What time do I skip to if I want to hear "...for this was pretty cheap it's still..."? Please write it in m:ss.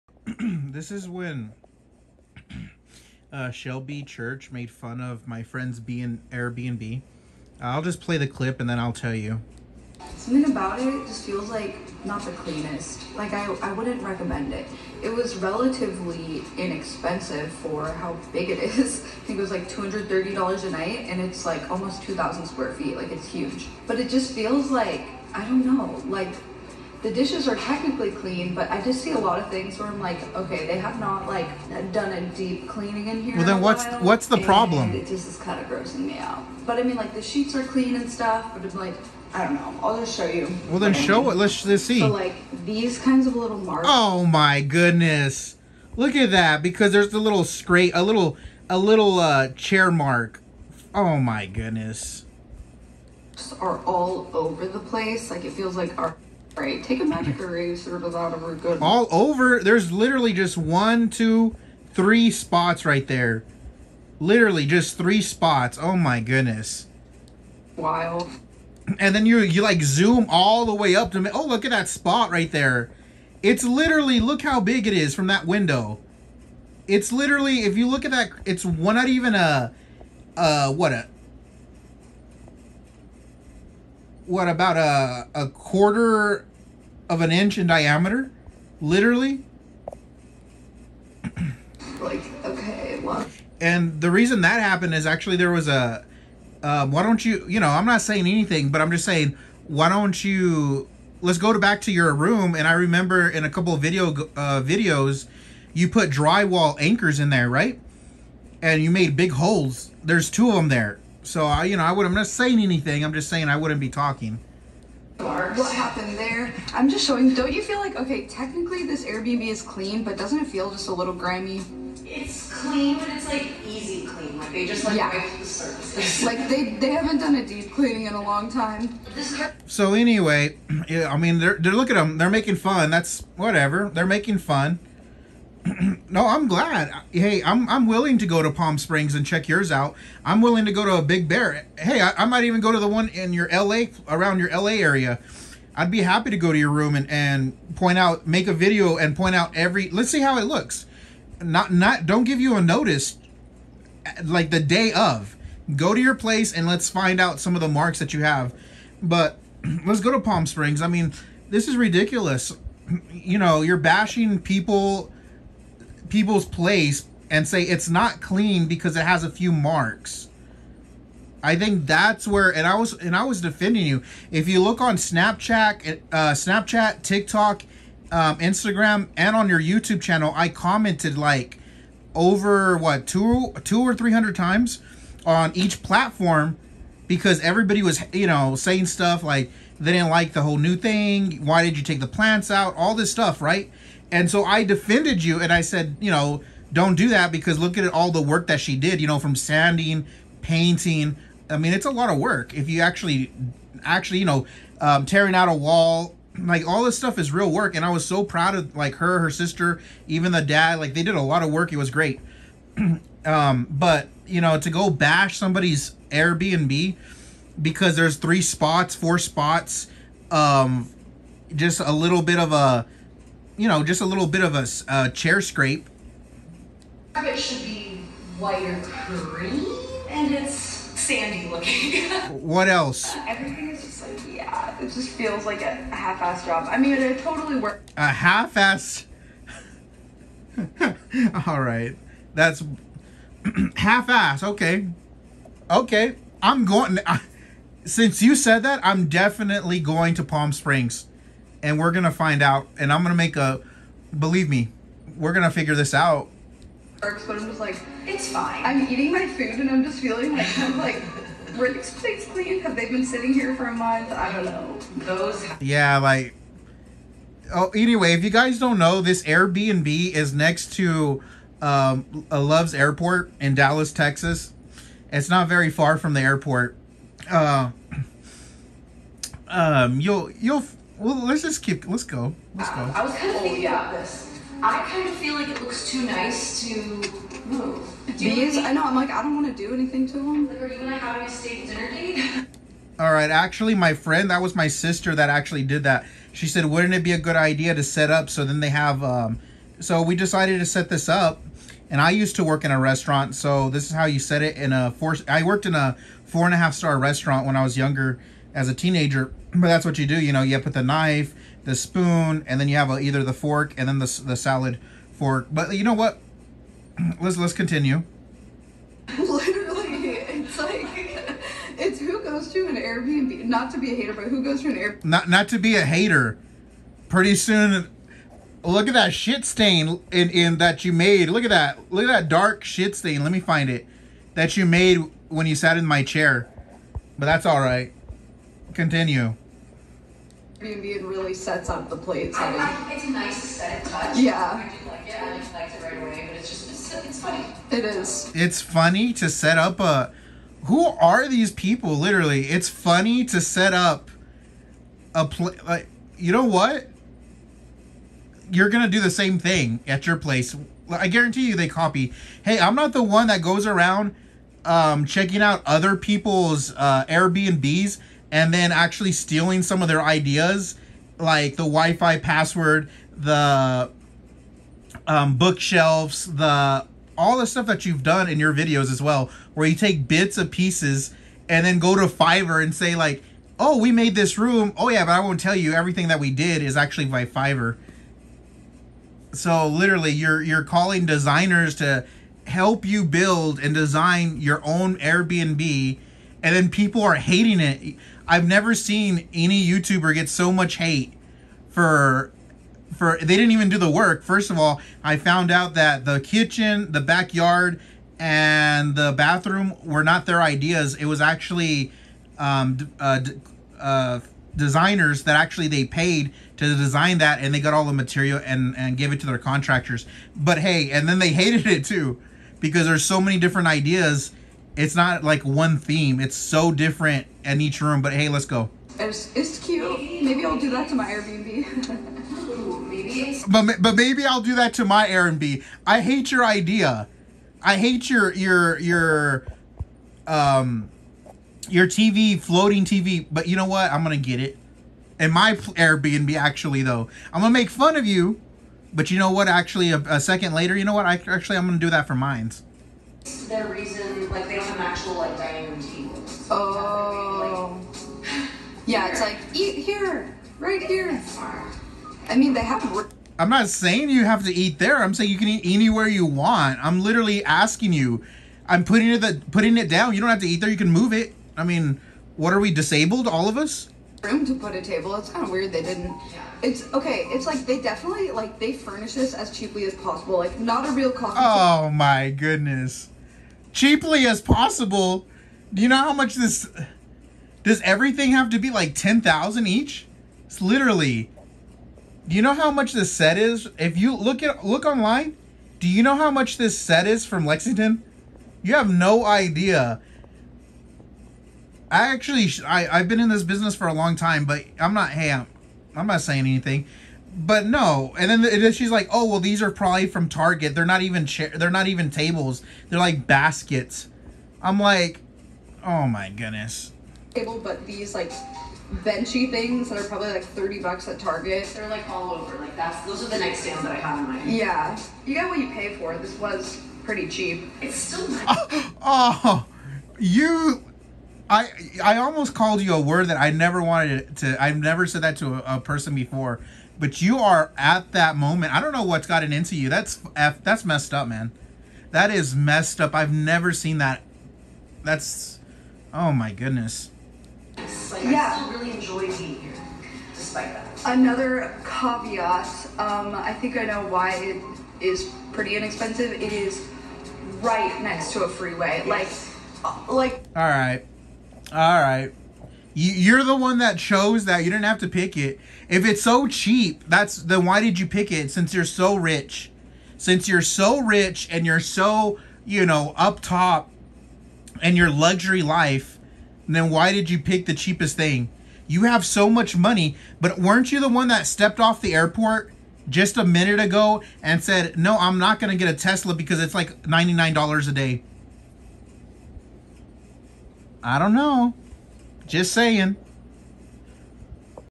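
8:45.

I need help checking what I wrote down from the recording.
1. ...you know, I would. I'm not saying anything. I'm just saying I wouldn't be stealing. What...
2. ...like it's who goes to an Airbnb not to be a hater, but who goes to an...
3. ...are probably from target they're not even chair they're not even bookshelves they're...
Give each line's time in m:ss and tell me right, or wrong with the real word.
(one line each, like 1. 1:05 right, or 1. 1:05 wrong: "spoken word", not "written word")
1. 1:51 wrong: "talking", not "stealing"
2. 5:20 right
3. 8:29 wrong: "tables", not "bookshelves".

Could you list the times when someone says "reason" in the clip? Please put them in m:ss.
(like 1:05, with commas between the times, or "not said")
1:34, 7:33.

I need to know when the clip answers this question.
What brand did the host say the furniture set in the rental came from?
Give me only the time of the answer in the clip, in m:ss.
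8:17.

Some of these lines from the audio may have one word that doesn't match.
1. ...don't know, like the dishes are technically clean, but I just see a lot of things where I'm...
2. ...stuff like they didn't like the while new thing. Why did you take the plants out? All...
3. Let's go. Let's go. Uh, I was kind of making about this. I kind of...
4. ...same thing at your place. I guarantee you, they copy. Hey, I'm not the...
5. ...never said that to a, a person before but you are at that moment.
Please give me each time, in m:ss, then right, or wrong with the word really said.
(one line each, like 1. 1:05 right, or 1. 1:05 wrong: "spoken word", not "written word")
1. 0:25 right
2. 3:08 wrong: "whole", not "while"
3. 4:41 wrong: "thinking", not "making"
4. 5:59 right
5. 8:54 right.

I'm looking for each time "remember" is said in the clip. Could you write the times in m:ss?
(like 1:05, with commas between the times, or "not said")
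1:42.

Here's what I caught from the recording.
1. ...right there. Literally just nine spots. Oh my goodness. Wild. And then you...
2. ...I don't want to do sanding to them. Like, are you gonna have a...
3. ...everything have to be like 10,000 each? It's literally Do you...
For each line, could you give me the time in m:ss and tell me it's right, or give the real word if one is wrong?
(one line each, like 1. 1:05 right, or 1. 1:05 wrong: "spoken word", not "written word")
1. 1:02 wrong: "three", not "nine"
2. 4:49 wrong: "anything", not "sanding"
3. 8:07 right.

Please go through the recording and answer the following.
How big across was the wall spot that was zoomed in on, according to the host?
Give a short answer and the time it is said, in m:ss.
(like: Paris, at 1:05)
A quarter of an inch, at 1:25.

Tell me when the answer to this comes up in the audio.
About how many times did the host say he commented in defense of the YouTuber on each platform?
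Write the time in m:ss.
3:03.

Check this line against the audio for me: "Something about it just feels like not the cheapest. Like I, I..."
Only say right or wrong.
wrong.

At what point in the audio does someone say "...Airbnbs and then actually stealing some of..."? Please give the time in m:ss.
6:07.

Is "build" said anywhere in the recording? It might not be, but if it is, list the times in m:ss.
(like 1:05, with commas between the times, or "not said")
6:33.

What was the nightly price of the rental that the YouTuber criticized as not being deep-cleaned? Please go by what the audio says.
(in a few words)
$230.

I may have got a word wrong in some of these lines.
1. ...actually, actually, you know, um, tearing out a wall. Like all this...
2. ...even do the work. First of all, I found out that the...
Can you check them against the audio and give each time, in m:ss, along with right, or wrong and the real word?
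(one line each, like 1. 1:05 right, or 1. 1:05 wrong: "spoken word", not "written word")
1. 3:22 right
2. 6:43 right.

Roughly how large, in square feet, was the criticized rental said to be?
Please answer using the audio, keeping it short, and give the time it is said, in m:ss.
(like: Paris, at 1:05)
2,000 square feet, at 0:22.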